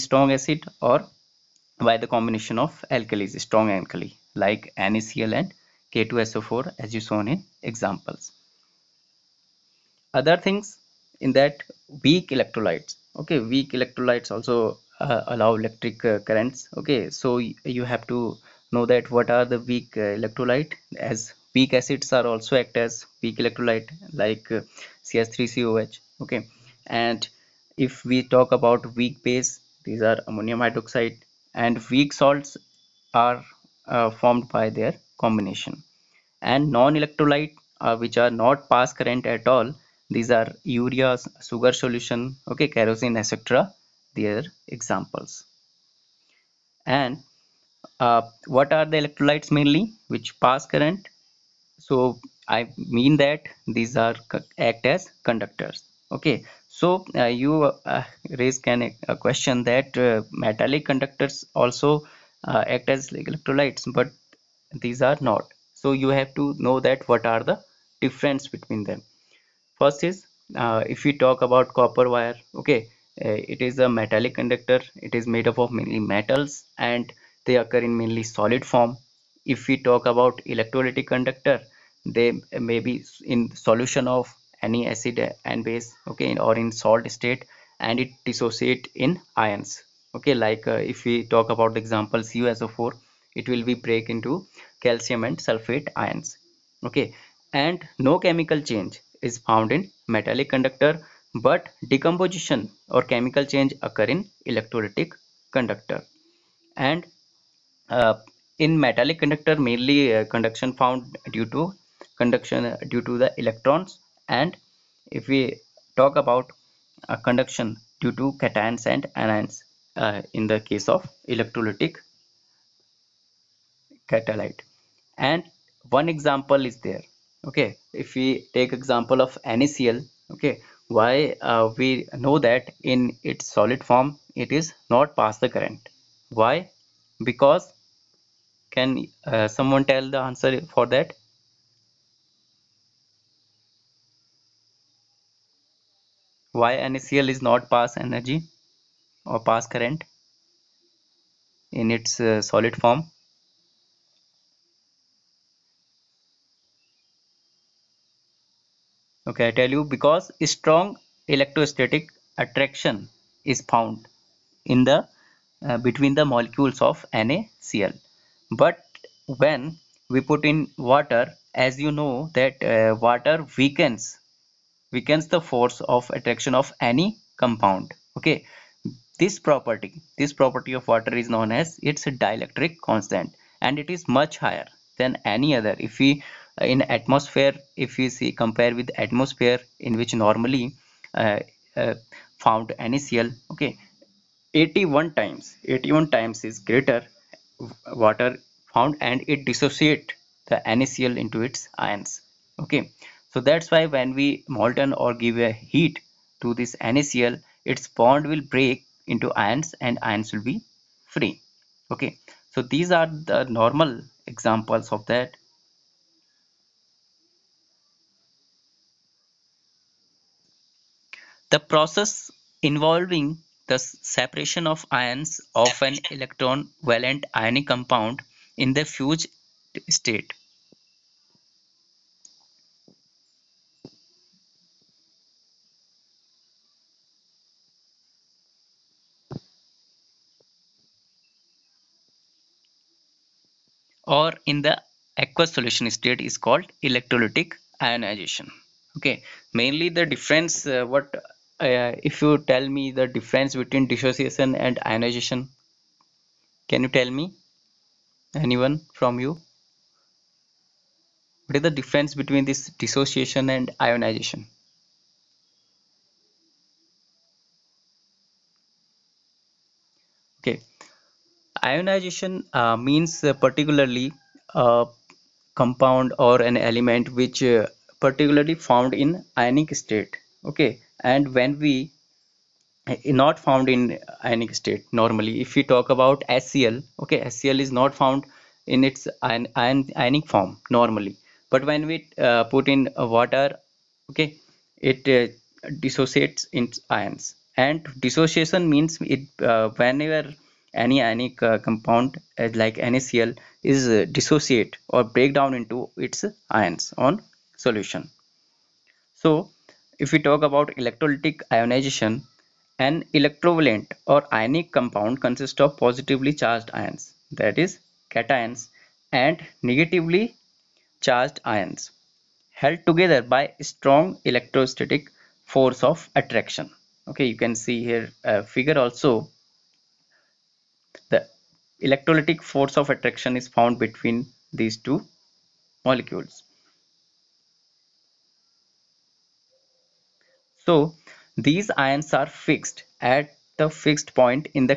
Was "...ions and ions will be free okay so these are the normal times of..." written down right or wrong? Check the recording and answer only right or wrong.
wrong.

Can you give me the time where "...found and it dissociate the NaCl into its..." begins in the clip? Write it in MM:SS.
03:18.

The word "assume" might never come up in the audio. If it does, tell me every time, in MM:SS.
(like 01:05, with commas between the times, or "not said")
not said.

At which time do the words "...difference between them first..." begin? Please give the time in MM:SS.
01:08.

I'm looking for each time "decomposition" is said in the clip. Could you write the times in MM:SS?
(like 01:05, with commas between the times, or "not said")
01:41.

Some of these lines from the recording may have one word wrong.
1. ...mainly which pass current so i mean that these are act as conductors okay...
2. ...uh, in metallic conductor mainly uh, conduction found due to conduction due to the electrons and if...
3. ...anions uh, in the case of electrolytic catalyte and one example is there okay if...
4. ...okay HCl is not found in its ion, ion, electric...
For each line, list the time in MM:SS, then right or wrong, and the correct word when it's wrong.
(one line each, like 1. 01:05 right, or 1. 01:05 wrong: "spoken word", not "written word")
1. 00:49 right
2. 01:47 right
3. 01:59 right
4. 04:47 wrong: "ionic", not "electric".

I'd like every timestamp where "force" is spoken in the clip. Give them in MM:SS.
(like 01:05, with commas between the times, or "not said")
02:55, 05:25, 05:32.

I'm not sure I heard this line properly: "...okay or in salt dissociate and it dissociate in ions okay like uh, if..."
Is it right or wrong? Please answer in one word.
wrong.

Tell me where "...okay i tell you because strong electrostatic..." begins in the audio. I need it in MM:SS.
02:39.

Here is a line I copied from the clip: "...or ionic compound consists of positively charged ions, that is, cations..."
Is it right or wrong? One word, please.
right.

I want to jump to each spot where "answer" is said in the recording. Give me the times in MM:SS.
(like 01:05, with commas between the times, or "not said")
02:20.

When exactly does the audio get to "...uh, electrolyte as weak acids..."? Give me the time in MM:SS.
00:19.